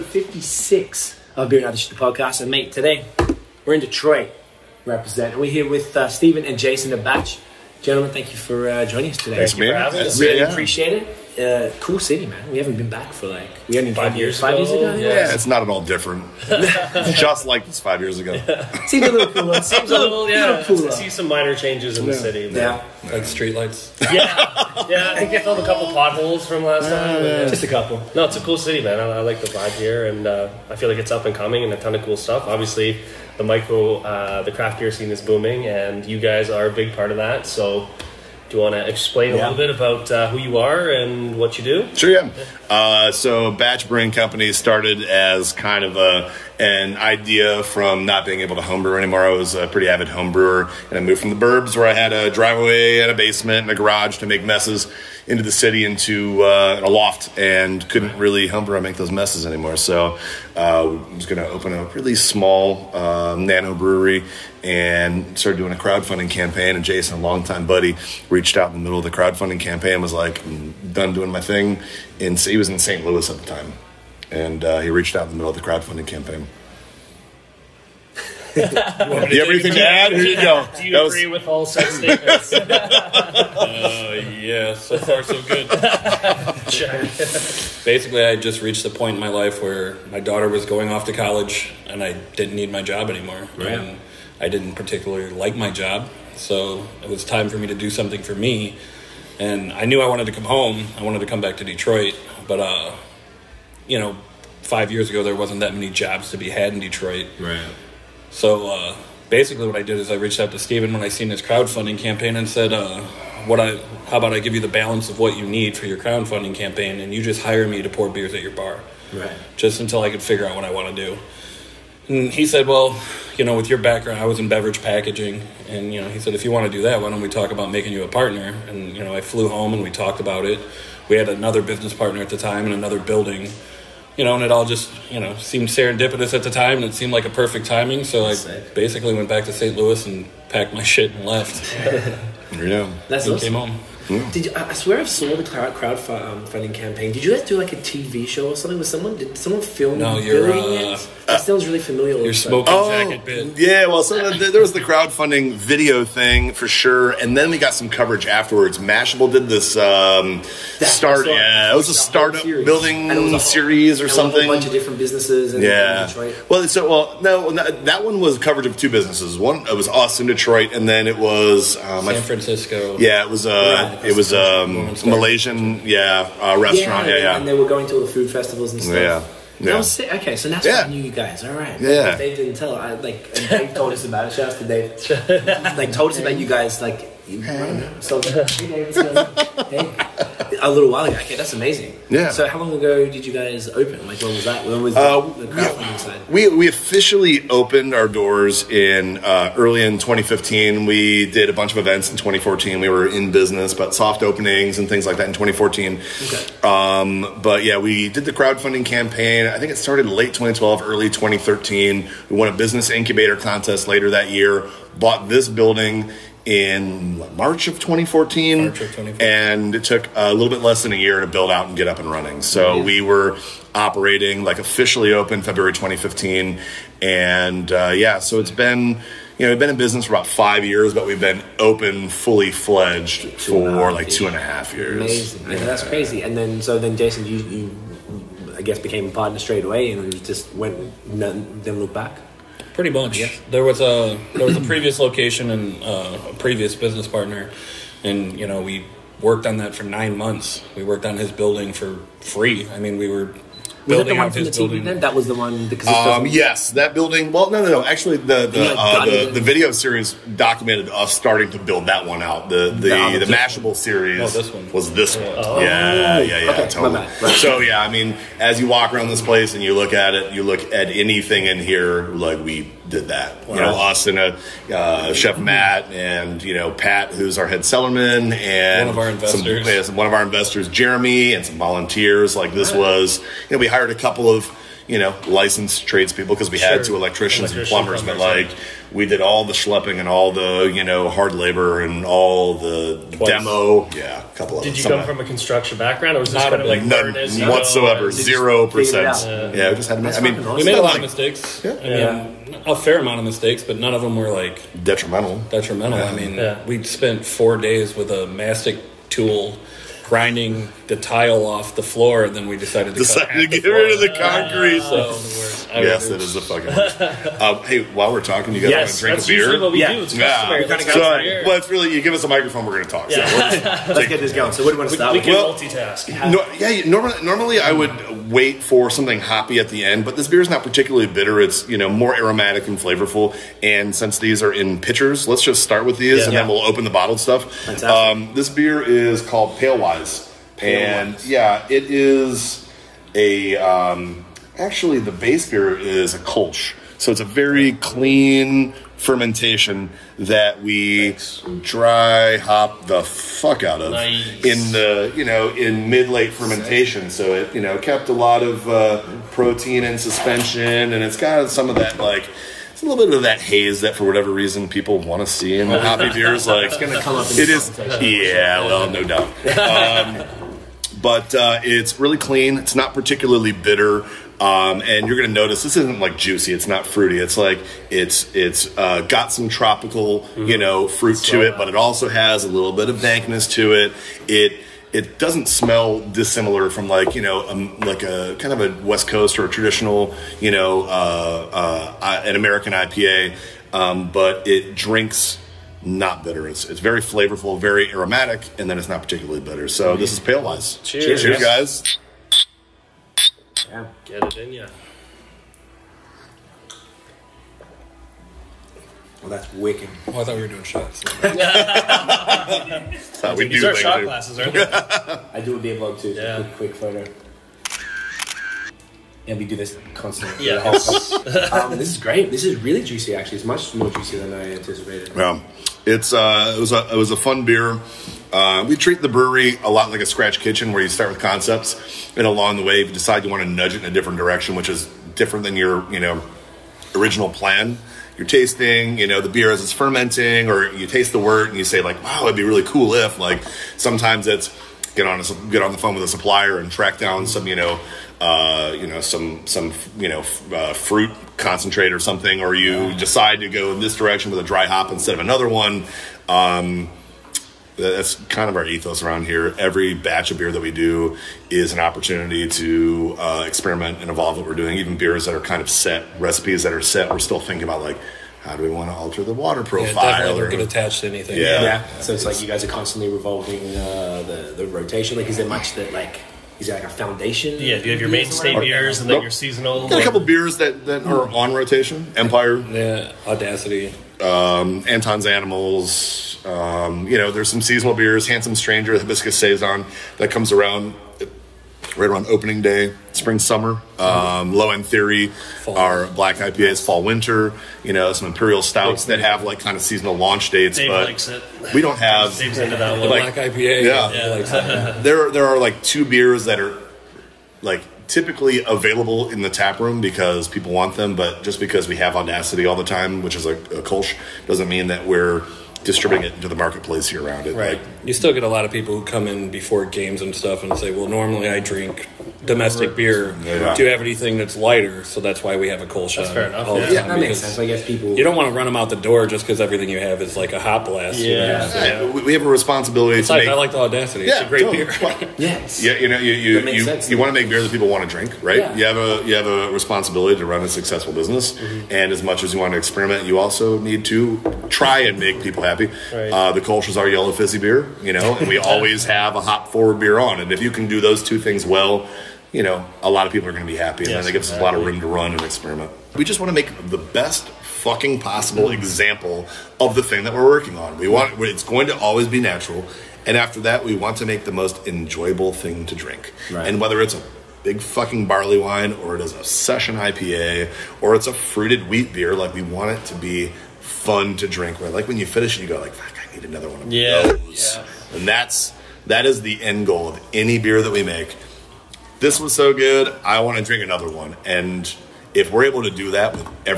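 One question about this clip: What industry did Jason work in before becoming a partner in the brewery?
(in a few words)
Beverage packaging.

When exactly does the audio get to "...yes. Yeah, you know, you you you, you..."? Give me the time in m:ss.
8:55.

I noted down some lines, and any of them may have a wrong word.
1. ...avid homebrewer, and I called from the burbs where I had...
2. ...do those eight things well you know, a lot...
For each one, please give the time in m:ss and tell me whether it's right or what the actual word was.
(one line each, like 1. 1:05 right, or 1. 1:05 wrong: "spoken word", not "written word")
1. 0:49 wrong: "moved", not "called"
2. 9:10 wrong: "two", not "eight".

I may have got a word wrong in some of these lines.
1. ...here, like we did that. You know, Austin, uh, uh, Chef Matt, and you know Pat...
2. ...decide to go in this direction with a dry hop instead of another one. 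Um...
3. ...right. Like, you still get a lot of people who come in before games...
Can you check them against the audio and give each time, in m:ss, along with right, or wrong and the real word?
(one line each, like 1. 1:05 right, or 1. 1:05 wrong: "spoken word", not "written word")
1. 4:31 right
2. 7:32 right
3. 8:37 right.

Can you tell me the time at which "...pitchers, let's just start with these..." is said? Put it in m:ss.
5:34.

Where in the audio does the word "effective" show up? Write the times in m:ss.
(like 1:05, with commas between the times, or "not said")
not said.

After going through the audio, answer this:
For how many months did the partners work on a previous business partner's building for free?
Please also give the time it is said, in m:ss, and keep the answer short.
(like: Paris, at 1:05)
9, at 4:09.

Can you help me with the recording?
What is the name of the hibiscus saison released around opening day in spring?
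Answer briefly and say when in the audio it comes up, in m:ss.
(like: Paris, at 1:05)
Handsome Stranger, at 8:08.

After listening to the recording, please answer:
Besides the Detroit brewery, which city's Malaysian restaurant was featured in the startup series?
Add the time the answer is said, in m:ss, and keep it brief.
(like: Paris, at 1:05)
San Francisco, at 2:52.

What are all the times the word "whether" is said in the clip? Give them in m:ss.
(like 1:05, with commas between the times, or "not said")
9:26.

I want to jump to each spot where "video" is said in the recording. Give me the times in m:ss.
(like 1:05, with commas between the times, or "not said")
2:35, 4:19.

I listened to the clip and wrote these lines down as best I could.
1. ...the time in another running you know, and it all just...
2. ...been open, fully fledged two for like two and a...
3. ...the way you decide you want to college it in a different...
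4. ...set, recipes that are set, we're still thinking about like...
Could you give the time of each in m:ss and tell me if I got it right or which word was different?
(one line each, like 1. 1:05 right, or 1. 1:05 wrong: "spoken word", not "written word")
1. 2:12 wrong: "building", not "running"
2. 3:51 right
3. 7:12 wrong: "nudge", not "college"
4. 7:45 right.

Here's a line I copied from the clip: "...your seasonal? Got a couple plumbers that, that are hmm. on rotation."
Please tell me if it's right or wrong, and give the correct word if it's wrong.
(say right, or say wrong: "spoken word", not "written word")
wrong: "beers", not "plumbers".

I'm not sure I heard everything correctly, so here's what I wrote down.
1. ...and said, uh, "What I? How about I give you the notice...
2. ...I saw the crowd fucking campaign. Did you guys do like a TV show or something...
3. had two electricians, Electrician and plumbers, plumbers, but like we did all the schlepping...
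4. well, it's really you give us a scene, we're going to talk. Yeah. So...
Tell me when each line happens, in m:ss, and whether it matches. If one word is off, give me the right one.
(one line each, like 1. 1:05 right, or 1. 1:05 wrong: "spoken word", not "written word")
1. 1:52 wrong: "balance", not "notice"
2. 2:25 wrong: "crowdfunding", not "fucking"
3. 4:46 right
4. 5:21 wrong: "microphone", not "scene".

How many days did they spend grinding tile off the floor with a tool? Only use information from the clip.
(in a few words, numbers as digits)
4.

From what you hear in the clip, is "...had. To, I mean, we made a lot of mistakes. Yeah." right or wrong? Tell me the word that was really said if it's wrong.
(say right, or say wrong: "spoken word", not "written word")
right.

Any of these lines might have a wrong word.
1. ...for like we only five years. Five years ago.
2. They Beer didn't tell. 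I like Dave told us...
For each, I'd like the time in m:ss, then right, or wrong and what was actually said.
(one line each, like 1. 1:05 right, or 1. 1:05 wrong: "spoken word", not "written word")
1. 0:13 right
2. 3:02 wrong: "Dave", not "Beer".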